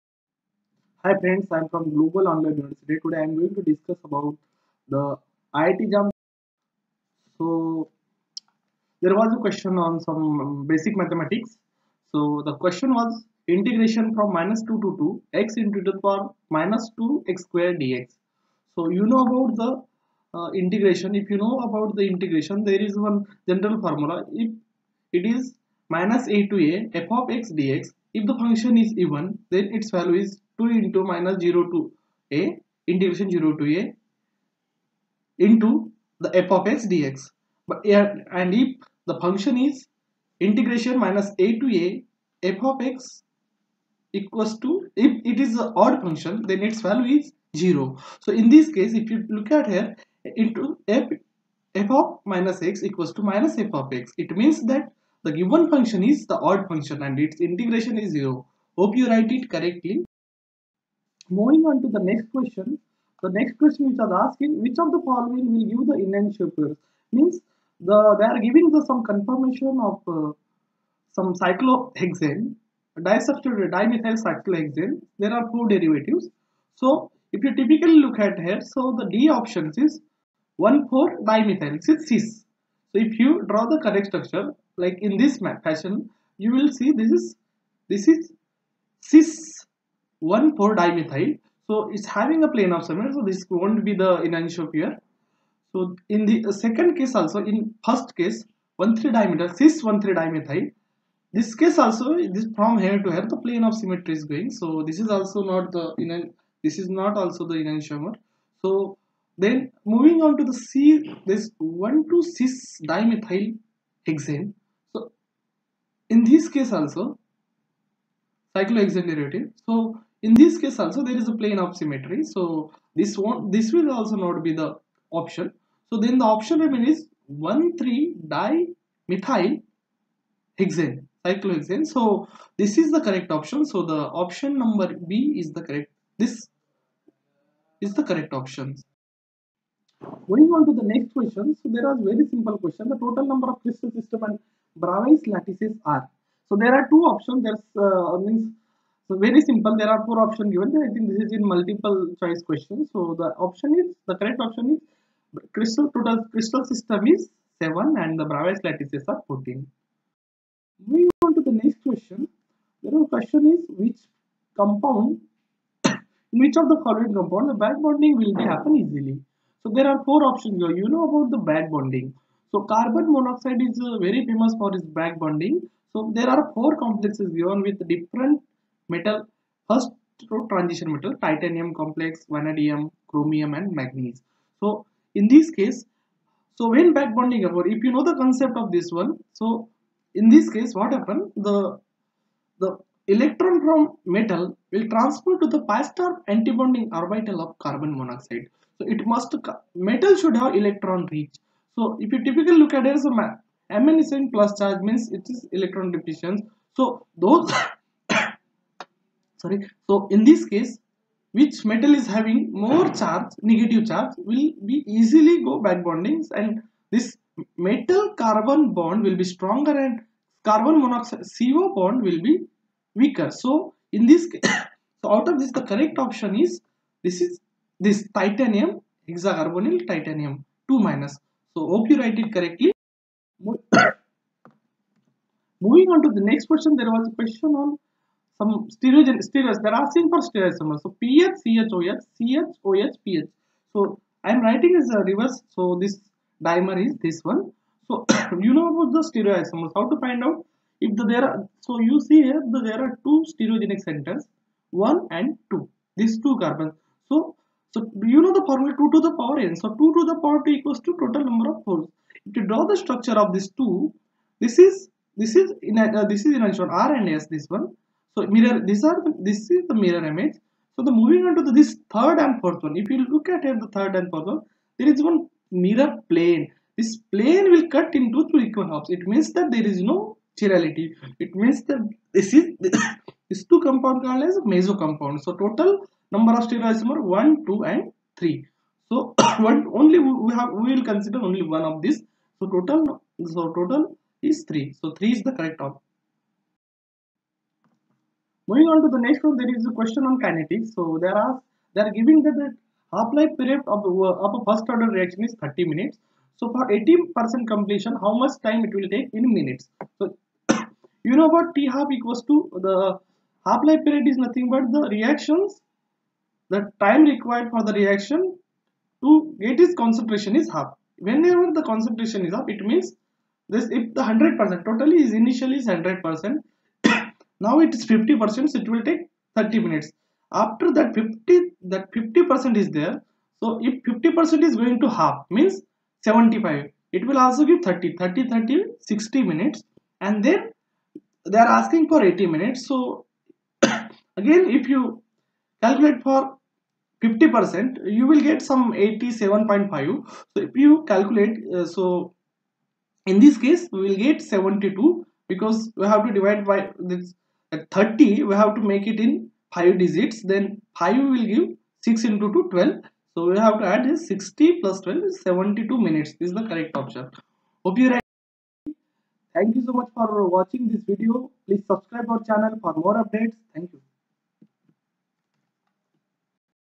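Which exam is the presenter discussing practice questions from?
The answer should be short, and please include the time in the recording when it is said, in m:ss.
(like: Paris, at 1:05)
IIT JAM, at 0:05.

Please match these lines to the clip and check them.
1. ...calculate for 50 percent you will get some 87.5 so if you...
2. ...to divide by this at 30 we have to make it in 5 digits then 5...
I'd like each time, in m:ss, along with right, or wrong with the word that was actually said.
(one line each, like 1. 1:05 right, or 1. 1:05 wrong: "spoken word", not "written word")
1. 5:45 right
2. 5:56 right.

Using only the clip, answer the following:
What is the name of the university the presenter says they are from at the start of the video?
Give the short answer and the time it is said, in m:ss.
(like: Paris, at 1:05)
Global Online University, at 0:01.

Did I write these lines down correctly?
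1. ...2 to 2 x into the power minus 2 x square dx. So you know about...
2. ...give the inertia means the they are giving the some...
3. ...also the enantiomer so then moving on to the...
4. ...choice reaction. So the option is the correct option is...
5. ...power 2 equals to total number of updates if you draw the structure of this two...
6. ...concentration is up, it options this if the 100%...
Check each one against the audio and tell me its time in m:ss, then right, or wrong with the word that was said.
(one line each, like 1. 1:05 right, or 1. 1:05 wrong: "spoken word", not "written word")
1. 0:14 right
2. 1:05 right
3. 1:47 right
4. 2:32 wrong: "question", not "reaction"
5. 4:20 wrong: "poles", not "updates"
6. 5:21 wrong: "means", not "options".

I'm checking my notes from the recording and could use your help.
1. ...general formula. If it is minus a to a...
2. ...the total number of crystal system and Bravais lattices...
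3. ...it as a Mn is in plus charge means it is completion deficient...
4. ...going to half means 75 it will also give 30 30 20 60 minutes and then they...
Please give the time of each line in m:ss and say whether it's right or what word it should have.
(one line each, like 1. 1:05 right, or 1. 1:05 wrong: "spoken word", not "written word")
1. 0:23 right
2. 2:22 right
3. 3:22 wrong: "electron", not "completion"
4. 5:34 wrong: "30", not "20".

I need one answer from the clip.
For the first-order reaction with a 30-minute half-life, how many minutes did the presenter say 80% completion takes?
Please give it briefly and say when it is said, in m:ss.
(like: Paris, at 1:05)
72, at 6:05.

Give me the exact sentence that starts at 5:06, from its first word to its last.
So for 80% completion, how much time it will take in minutes?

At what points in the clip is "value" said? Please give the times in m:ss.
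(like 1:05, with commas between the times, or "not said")
0:29, 0:46.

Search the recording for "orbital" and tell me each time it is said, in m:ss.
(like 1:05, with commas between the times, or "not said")
3:17.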